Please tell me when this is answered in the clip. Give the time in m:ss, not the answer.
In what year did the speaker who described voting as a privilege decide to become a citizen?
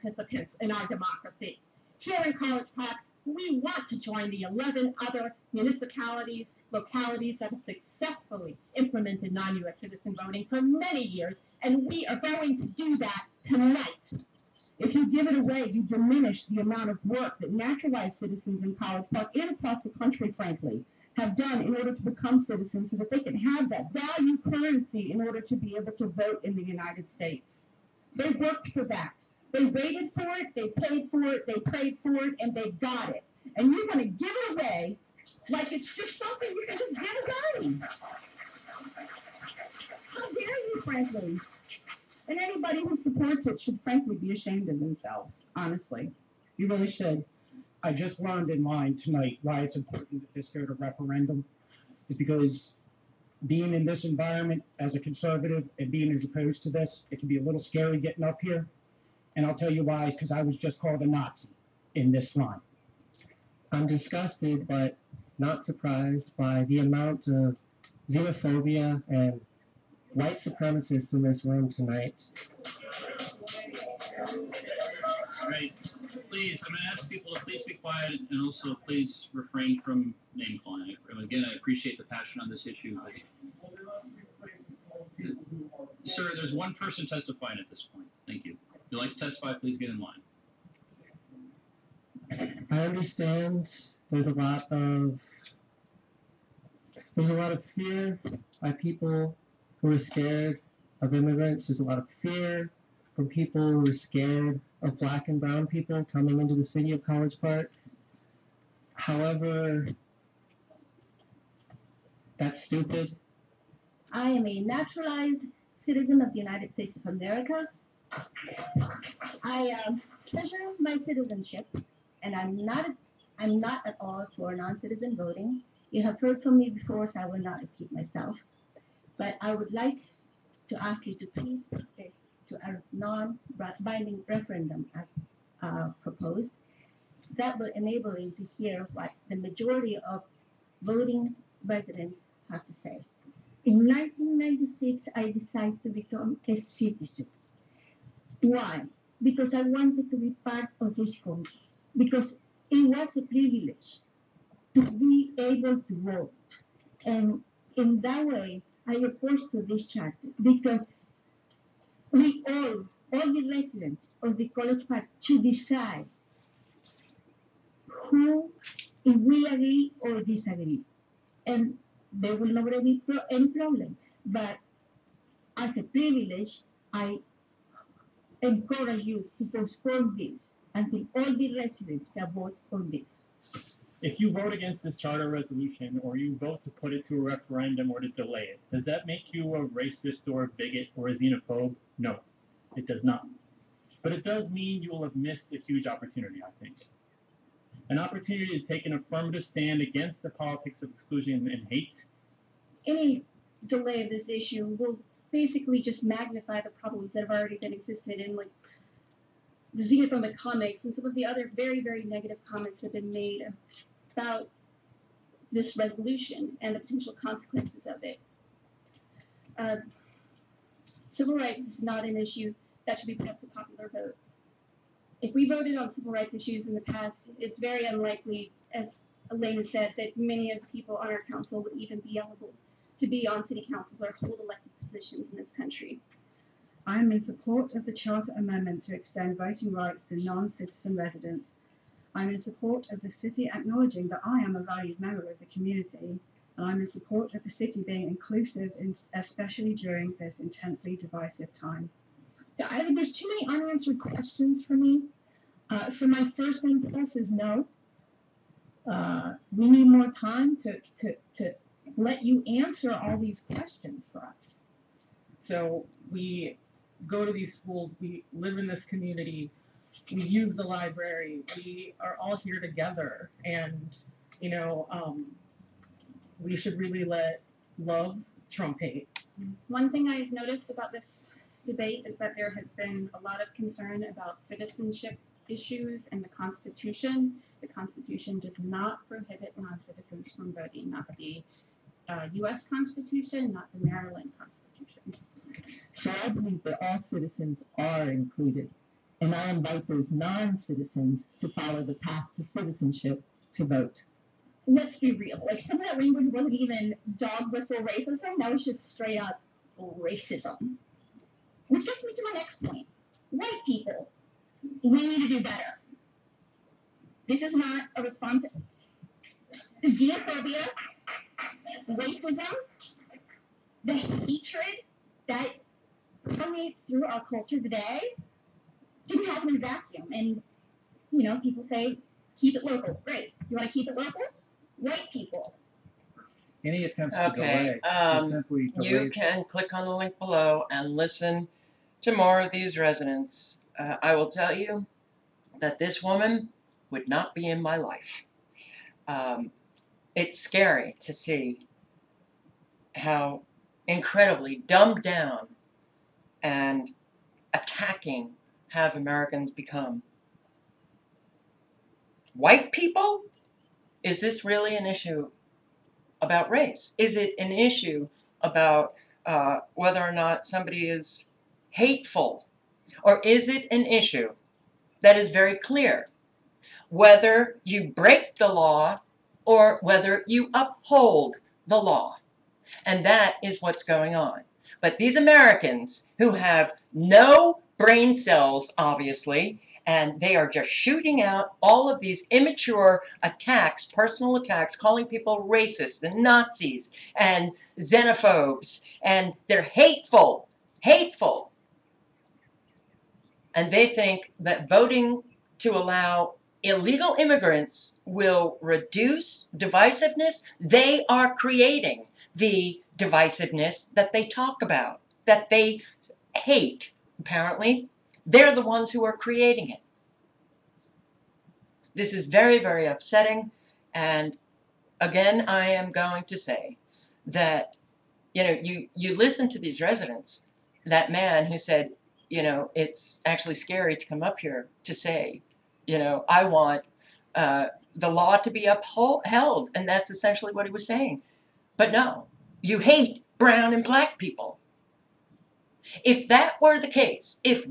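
2:23.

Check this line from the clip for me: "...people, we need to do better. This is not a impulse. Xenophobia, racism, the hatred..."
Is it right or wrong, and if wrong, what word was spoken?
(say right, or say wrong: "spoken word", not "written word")
wrong: "response", not "impulse".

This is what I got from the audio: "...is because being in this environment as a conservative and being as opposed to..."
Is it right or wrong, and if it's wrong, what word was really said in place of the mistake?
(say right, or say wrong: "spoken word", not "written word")
right.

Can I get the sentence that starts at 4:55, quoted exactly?
So I believe that all citizens are included, and I invite those non-citizens to follow the path to citizenship to vote.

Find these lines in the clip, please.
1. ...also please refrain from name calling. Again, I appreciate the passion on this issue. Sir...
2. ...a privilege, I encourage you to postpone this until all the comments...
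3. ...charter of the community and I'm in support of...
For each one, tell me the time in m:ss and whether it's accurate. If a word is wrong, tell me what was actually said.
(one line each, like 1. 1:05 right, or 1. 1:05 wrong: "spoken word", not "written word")
1. 1:18 right
2. 2:55 wrong: "residents", not "comments"
3. 4:04 wrong: "member", not "charter".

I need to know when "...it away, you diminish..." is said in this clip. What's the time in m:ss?
0:15.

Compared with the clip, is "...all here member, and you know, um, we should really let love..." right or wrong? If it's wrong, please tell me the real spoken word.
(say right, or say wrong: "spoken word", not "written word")
wrong: "together", not "member".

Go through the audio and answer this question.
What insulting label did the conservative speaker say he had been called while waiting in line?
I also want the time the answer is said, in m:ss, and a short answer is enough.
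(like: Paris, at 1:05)
Nazi, at 1:01.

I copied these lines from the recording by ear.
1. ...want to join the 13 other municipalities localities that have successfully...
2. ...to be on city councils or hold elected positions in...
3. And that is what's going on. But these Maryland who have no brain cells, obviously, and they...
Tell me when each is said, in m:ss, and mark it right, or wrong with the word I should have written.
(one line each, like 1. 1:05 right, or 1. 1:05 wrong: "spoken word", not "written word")
1. 0:03 wrong: "11", not "13"
2. 3:52 right
3. 6:22 wrong: "Americans", not "Maryland".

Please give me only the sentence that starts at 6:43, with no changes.
And they think that voting to allow illegal immigrants will reduce divisiveness.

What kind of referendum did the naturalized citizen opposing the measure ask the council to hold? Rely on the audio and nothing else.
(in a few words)
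Non-binding.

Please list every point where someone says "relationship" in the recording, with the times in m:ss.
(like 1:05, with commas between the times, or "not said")
not said.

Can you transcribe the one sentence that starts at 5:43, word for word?
Uh, I will tell you that this woman would not be in my life.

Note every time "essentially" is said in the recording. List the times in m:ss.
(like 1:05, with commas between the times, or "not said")
7:20.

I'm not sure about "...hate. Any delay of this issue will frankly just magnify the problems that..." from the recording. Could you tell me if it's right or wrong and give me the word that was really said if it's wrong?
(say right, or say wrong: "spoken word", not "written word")
wrong: "basically", not "frankly".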